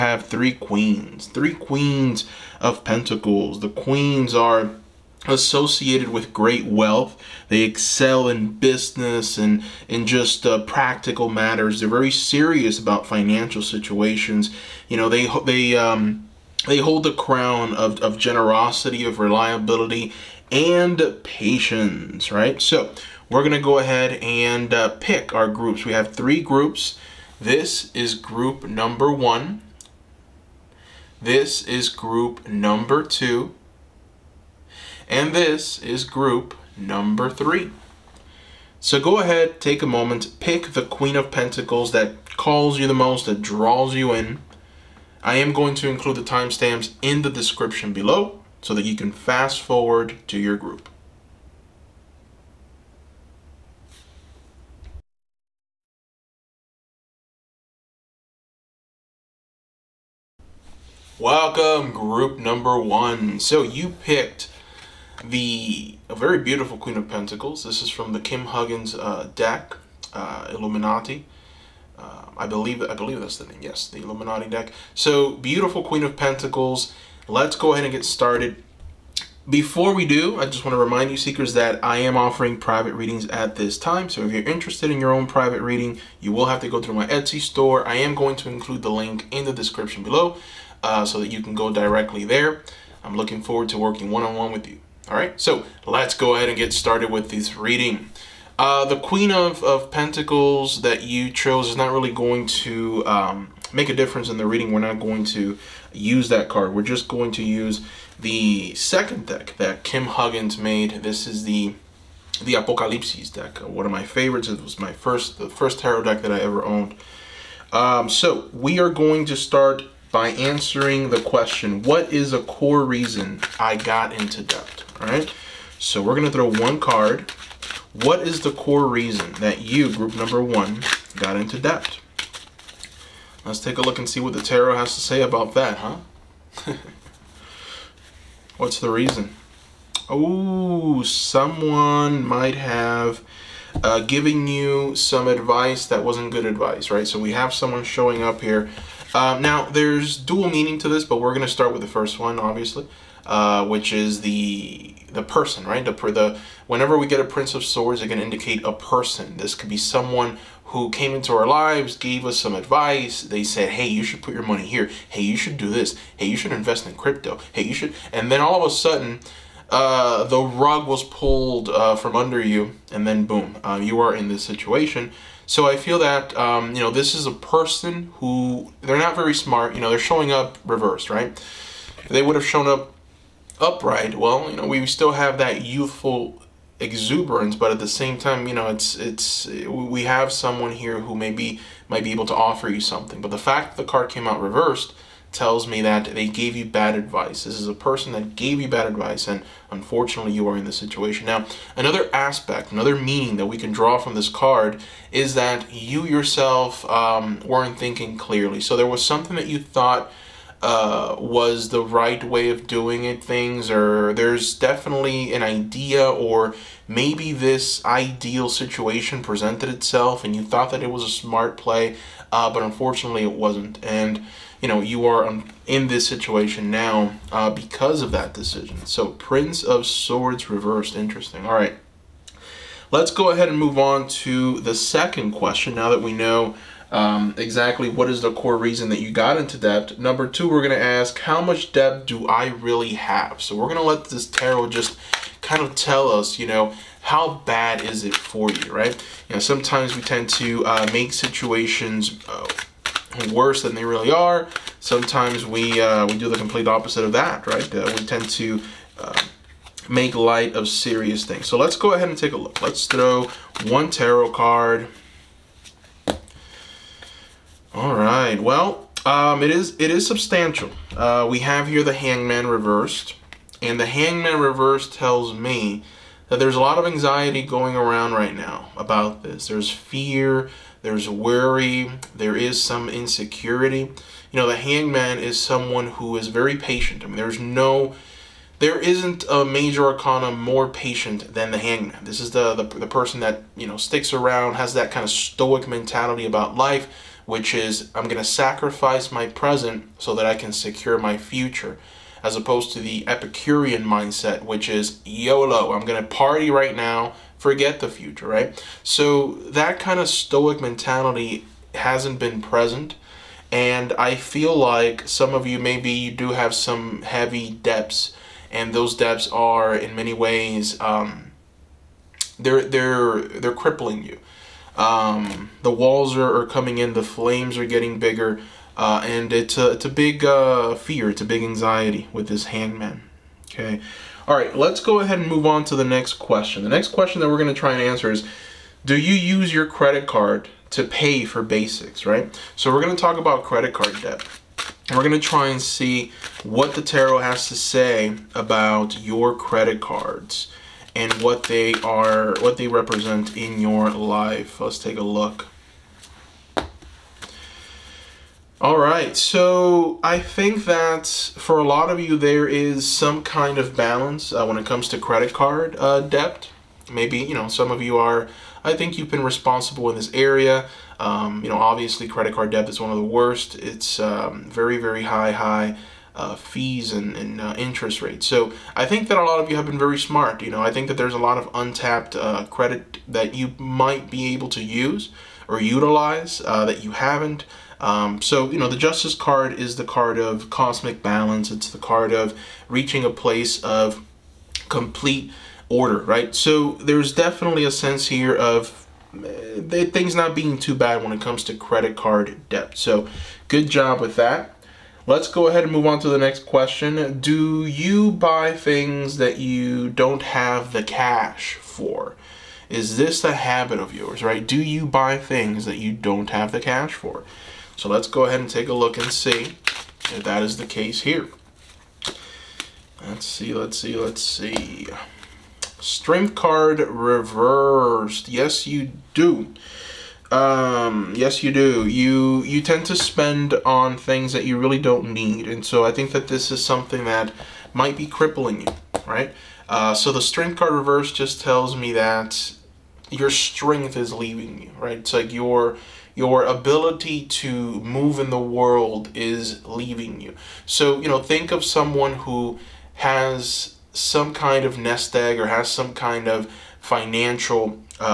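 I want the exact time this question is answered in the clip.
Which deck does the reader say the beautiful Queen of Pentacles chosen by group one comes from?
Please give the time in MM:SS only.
01:13.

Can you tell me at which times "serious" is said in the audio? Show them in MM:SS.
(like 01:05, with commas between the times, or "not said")
00:12, 04:20.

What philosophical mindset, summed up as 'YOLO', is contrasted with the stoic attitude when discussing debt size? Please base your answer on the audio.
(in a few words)
Epicurean.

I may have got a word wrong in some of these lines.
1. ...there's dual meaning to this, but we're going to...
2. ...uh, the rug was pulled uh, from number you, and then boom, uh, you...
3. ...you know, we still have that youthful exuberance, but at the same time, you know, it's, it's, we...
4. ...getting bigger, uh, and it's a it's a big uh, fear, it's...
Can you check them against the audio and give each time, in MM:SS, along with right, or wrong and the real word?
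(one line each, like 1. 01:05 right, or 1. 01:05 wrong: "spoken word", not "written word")
1. 02:29 right
2. 02:49 wrong: "under", not "number"
3. 03:04 right
4. 05:27 right.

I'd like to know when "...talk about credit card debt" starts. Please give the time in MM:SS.
05:42.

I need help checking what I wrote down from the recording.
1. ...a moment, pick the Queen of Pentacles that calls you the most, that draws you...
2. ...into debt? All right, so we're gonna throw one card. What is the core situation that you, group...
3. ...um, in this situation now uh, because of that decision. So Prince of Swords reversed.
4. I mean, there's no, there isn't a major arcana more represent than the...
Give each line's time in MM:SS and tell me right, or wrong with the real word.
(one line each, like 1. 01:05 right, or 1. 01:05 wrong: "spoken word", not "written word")
1. 00:39 right
2. 02:04 wrong: "reason", not "situation"
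3. 03:45 right
4. 04:47 wrong: "patient", not "represent".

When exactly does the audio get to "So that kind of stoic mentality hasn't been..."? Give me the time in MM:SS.
05:08.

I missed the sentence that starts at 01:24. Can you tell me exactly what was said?
So if you're interested in your own private reading, you will have to go through my Etsy store.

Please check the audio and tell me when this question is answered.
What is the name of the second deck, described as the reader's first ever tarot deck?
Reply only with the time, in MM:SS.
01:52.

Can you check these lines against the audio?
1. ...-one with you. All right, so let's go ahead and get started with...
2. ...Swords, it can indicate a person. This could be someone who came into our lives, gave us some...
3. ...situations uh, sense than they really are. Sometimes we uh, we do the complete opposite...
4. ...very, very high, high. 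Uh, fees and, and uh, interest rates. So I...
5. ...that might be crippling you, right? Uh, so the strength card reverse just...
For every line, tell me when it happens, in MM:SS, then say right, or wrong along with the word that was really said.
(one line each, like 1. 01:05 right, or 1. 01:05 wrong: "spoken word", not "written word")
1. 01:34 right
2. 02:37 right
3. 04:11 wrong: "worse", not "sense"
4. 06:14 right
5. 07:17 right.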